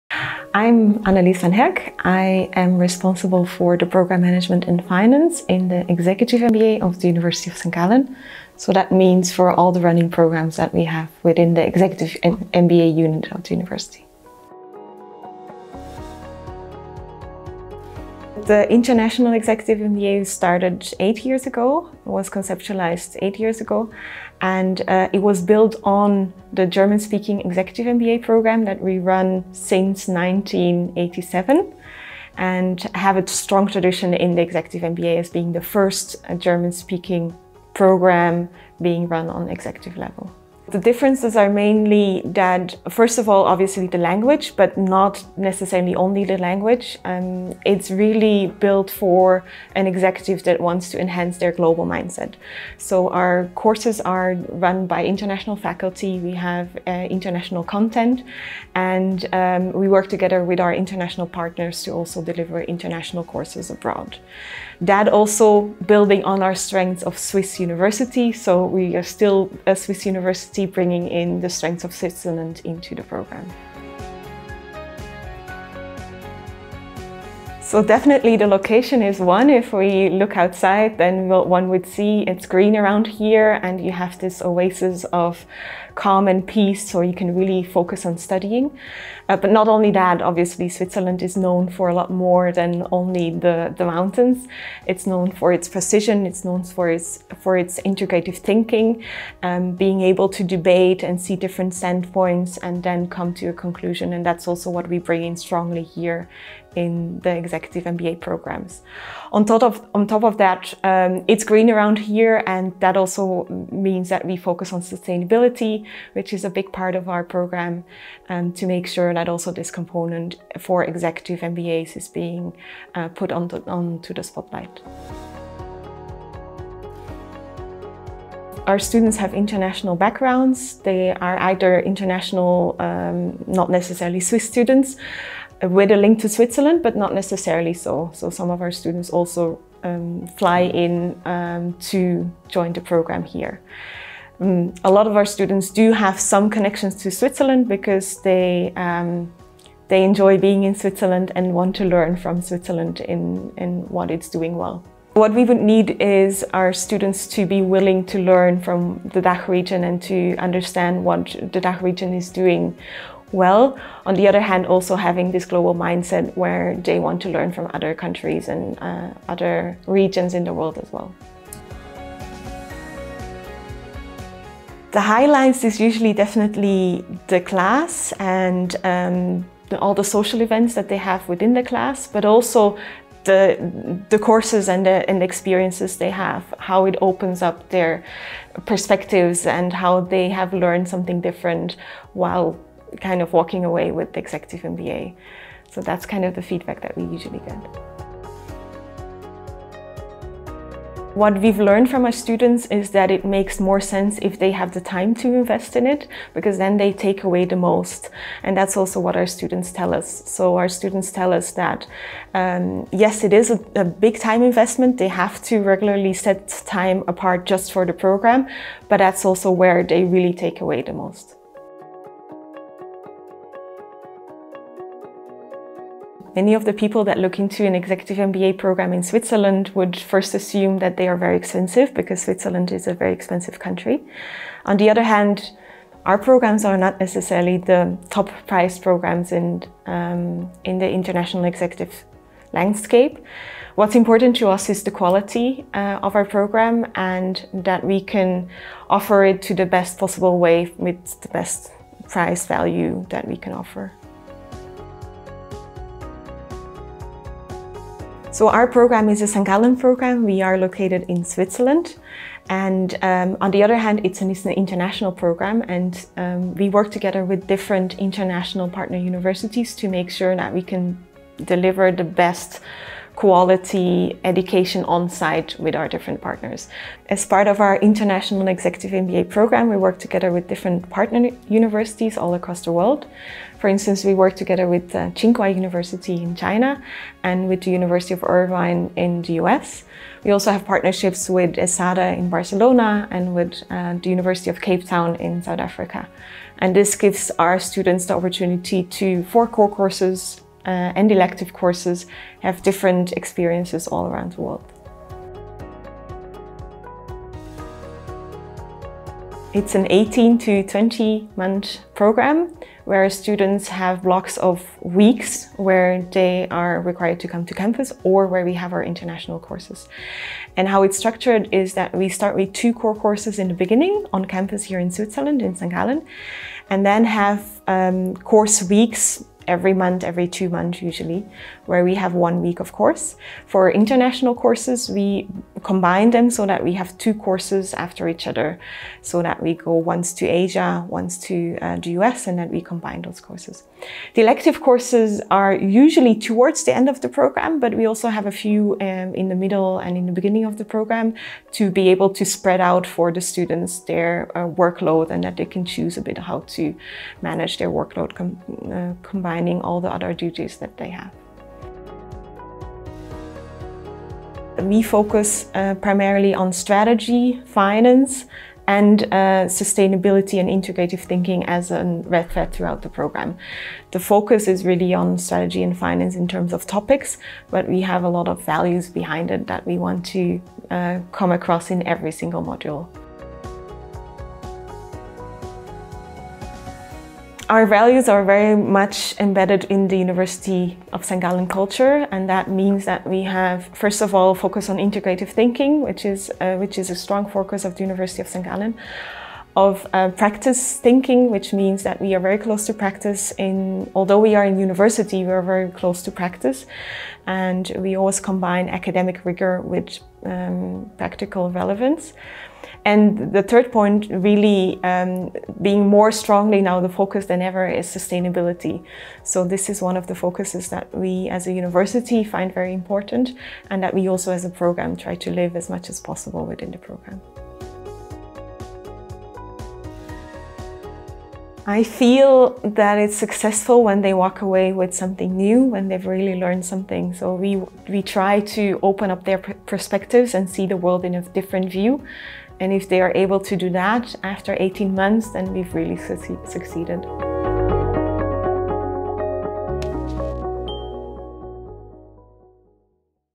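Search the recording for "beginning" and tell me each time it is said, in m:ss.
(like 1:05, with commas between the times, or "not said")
5:23, 5:50.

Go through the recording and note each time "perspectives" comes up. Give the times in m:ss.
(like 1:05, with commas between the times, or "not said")
3:08, 7:19.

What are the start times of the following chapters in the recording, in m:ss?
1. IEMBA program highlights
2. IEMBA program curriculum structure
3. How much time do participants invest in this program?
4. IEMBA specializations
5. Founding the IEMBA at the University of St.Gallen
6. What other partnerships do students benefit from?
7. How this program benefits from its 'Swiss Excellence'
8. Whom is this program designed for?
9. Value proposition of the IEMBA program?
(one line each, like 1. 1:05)
1. 2:53
2. 5:08
3. 3:20
4. 6:03
5. 0:15
6. 4:16
7. 1:15
8. 2:08
9. 3:44.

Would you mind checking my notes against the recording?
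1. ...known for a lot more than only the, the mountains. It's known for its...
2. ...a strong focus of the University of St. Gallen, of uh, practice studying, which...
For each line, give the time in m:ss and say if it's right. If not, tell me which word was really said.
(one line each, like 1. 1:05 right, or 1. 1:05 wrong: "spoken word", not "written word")
1. 1:31 right
2. 6:36 wrong: "thinking", not "studying".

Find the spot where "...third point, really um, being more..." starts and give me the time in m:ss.
6:53.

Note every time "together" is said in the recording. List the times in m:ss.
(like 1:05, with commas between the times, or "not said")
1:00, 4:26, 4:39, 4:44.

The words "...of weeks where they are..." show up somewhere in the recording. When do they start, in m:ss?
5:14.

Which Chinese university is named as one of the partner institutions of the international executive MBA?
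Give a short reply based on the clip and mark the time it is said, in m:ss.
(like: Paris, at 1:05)
Tsinghua University, at 4:45.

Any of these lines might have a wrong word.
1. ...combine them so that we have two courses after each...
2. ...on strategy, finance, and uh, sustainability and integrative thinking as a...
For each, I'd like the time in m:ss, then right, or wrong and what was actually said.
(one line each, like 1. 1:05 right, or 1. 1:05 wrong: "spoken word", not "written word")
1. 5:35 right
2. 6:06 right.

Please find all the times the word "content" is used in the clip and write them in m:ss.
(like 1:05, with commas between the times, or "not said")
0:57.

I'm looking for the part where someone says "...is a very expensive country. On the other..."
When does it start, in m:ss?
3:52.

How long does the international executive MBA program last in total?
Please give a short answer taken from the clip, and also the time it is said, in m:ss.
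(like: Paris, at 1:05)
18 to 20 months, at 5:09.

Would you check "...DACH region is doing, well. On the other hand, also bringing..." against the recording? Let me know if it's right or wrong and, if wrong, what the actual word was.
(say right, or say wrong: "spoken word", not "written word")
wrong: "having", not "bringing".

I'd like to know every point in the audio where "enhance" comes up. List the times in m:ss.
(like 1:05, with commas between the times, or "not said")
0:50.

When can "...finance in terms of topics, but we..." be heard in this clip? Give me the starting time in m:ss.
6:15.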